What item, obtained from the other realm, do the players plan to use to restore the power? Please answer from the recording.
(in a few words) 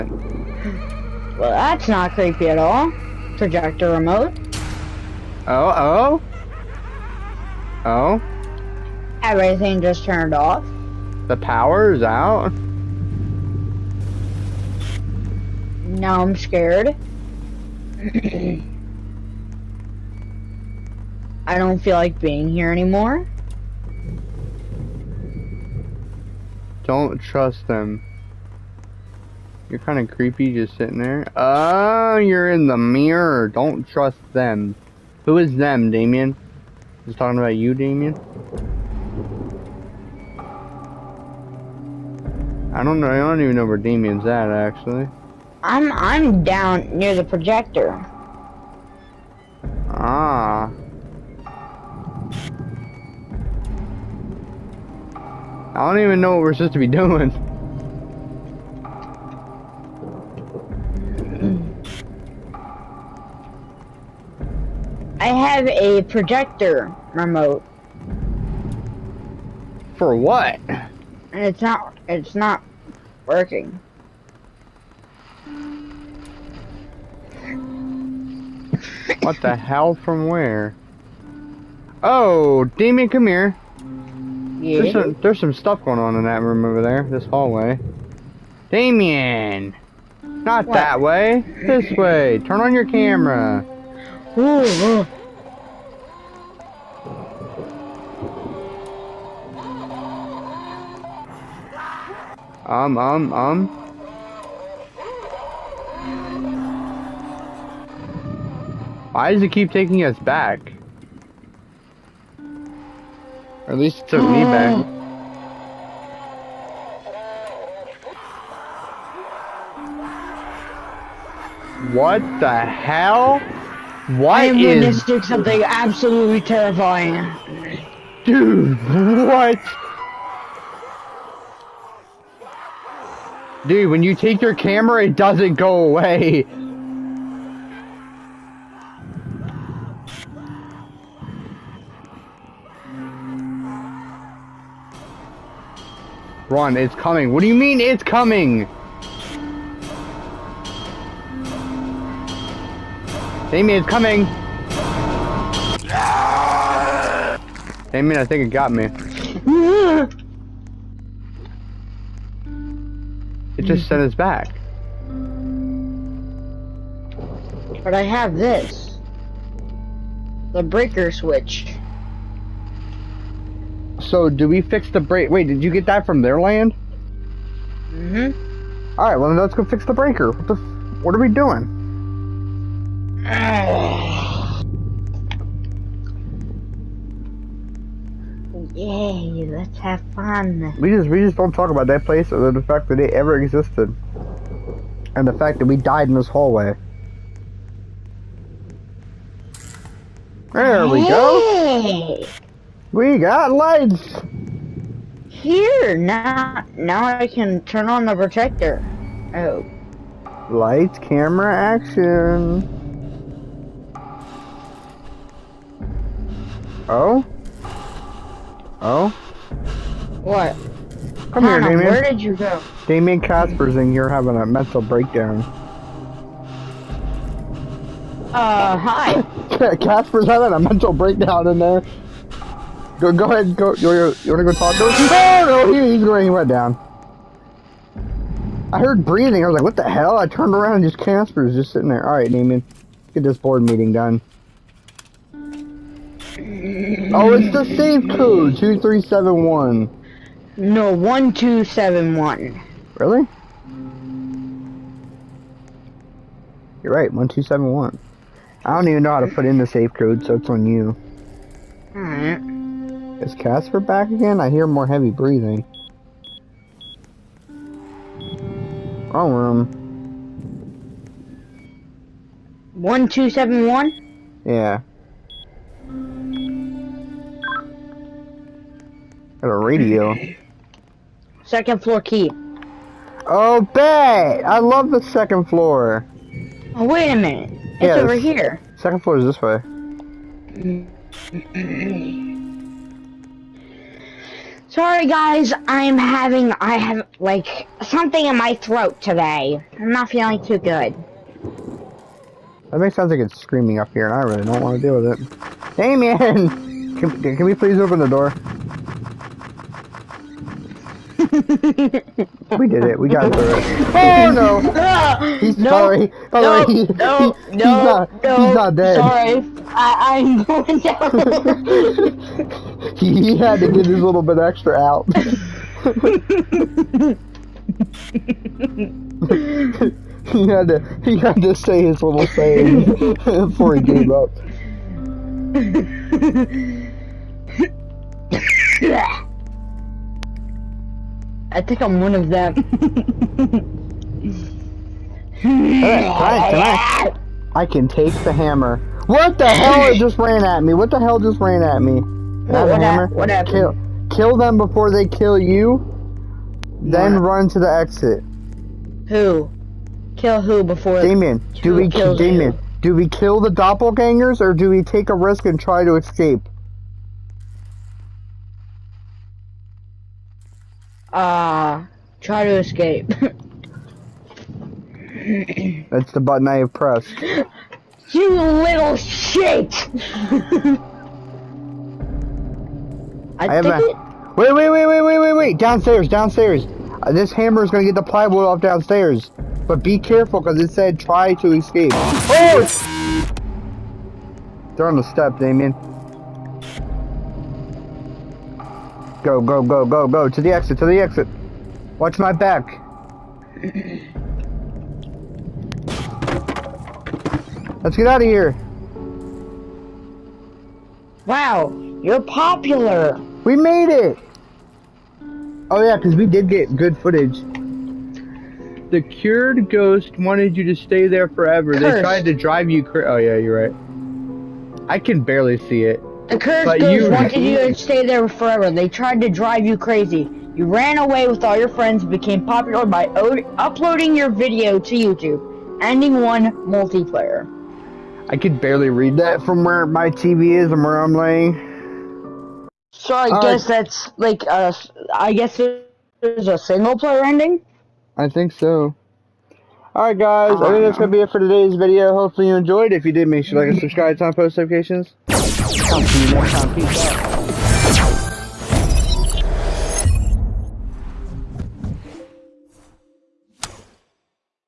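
Breaker switch.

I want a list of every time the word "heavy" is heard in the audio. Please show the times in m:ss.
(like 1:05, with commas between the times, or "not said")
4:24.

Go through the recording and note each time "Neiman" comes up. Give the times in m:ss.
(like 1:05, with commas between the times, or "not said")
4:02.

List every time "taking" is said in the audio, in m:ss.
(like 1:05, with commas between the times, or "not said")
1:49.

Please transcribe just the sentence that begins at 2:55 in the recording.
Wait, did you get that from their land?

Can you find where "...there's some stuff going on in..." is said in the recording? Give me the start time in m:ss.
1:25.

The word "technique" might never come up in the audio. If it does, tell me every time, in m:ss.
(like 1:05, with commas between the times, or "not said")
not said.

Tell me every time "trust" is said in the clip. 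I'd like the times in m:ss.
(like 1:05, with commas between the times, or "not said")
0:27, 0:33.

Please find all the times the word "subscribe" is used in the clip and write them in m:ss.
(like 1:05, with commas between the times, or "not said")
7:33.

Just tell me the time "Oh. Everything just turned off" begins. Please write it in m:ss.
0:07.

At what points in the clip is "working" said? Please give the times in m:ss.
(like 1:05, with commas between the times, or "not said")
1:13.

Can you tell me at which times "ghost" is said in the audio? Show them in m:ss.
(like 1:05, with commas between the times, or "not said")
6:59, 7:06.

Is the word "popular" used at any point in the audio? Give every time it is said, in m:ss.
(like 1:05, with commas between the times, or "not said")
6:52, 7:12.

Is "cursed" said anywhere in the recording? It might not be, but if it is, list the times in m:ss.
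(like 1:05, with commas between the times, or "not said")
7:01, 7:06.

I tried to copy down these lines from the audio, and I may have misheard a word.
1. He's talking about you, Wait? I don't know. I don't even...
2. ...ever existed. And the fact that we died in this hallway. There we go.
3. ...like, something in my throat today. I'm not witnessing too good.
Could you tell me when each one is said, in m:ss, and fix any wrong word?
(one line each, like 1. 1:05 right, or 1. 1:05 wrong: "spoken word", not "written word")
1. 0:37 wrong: "Damien", not "Wait"
2. 3:13 right
3. 4:57 wrong: "feeling", not "witnessing".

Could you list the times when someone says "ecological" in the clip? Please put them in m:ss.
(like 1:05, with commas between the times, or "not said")
not said.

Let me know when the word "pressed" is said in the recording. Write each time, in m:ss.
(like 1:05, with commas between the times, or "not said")
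6:16.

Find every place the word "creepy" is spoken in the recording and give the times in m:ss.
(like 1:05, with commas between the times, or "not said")
0:02, 0:30.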